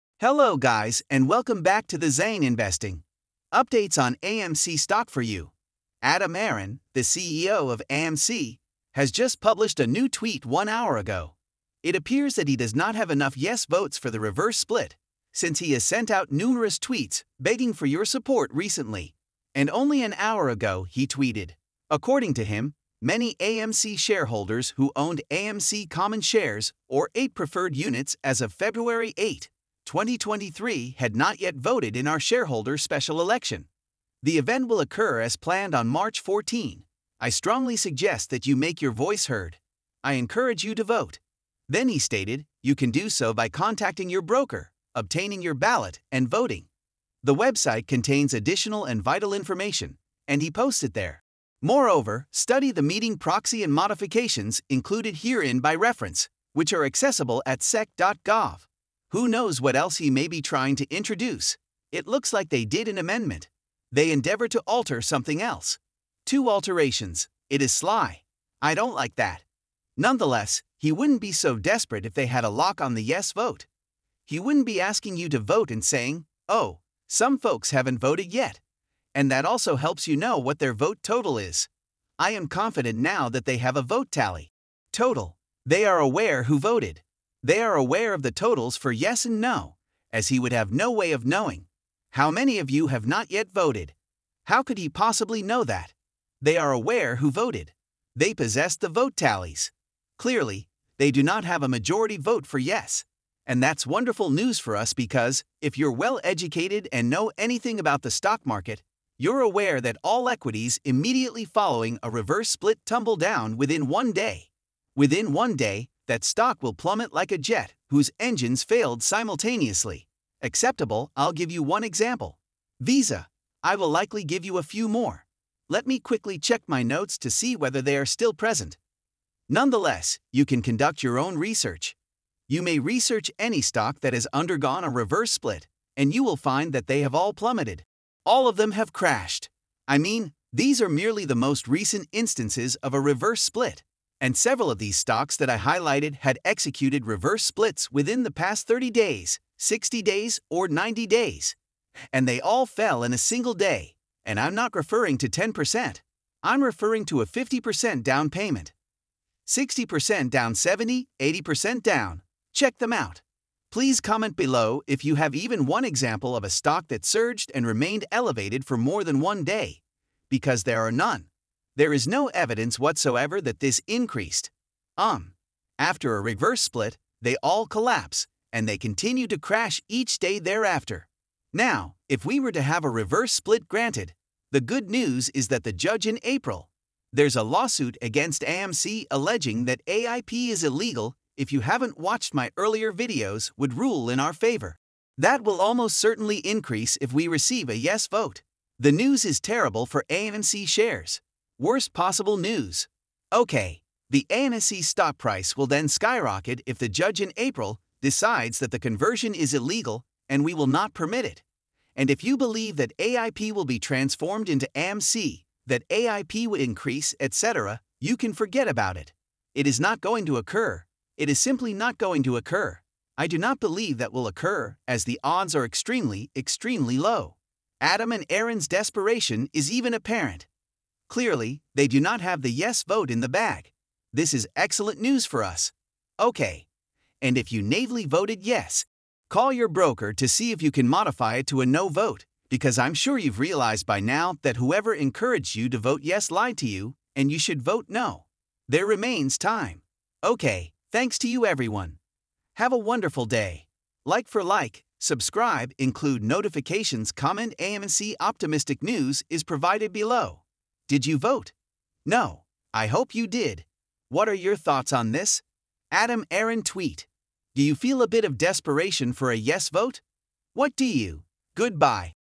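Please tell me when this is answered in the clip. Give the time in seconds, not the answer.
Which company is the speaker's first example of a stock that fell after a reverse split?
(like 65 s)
122 s.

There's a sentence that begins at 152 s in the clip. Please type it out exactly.
And they all fell in a single day, and I'm not referring to 10%.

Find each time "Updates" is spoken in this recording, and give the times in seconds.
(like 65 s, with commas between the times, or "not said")
3 s.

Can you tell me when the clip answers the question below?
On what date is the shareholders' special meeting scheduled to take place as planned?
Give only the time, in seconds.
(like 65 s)
35 s.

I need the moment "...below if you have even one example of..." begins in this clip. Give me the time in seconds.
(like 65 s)
164 s.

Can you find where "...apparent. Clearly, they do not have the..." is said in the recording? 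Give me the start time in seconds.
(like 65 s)
229 s.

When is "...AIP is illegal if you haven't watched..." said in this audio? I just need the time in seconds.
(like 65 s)
189 s.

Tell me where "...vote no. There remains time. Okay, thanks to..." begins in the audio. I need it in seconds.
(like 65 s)
247 s.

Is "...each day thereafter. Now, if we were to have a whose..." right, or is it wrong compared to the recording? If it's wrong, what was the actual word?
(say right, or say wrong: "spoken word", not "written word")
wrong: "reverse", not "whose".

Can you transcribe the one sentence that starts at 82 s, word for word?
I am confident now that they have a vote tally.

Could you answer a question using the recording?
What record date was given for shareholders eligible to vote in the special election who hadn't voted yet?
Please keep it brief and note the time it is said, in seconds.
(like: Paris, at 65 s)
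February 8 2023, at 28 s.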